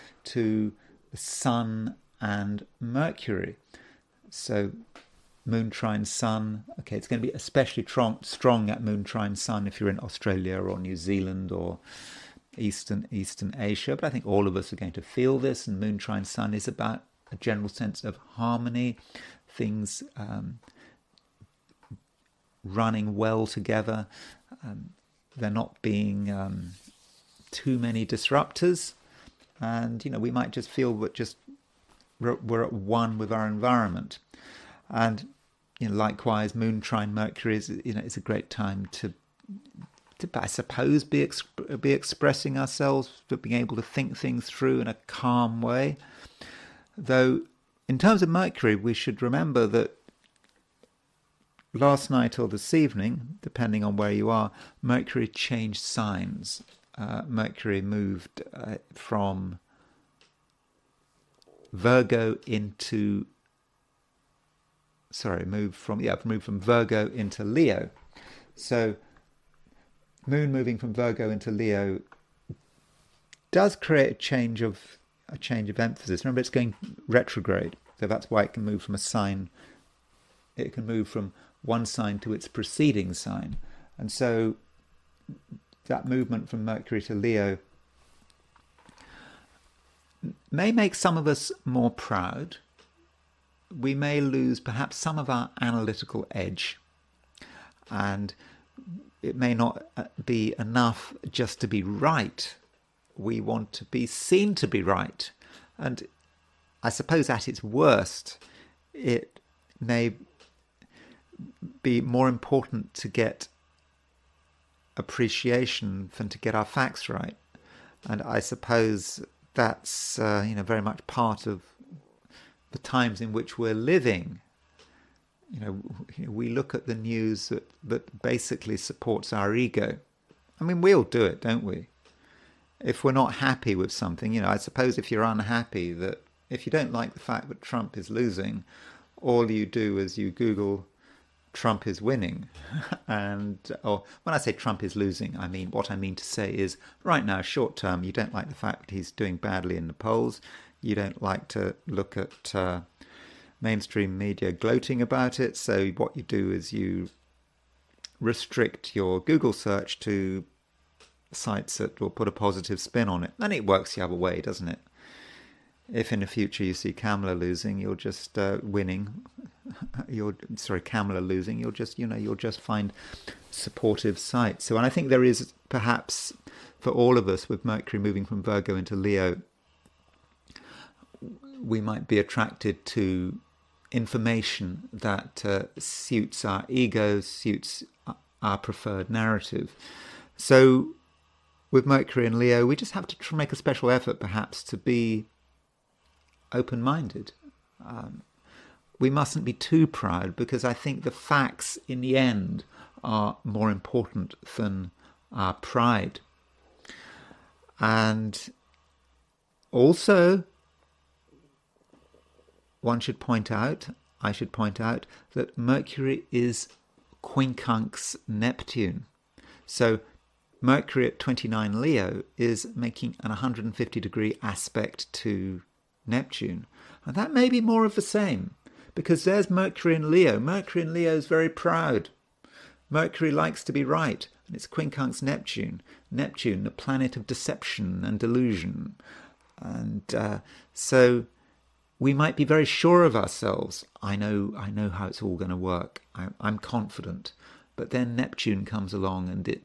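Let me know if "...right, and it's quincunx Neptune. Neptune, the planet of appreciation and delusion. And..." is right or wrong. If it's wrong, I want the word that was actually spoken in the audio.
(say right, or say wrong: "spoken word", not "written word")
wrong: "deception", not "appreciation".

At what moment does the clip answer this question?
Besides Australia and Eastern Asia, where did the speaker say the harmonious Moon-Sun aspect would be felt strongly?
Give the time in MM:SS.
00:10.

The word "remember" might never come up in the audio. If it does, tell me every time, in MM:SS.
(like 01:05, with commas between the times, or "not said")
00:49, 01:16.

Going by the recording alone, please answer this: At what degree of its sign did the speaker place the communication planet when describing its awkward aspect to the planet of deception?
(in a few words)
29 Leo.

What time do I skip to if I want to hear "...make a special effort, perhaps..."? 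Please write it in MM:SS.
03:13.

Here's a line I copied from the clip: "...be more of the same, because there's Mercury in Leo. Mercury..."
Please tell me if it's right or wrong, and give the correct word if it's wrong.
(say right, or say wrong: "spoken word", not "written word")
right.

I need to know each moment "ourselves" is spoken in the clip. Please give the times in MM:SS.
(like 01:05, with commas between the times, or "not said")
00:42, 04:03.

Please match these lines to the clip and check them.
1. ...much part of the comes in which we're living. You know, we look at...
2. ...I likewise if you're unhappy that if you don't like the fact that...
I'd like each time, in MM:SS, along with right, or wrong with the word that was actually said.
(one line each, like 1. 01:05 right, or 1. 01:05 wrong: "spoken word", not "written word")
1. 02:00 wrong: "times", not "comes"
2. 02:14 wrong: "suppose", not "likewise".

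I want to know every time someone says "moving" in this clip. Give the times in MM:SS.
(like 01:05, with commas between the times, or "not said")
01:10, 02:58.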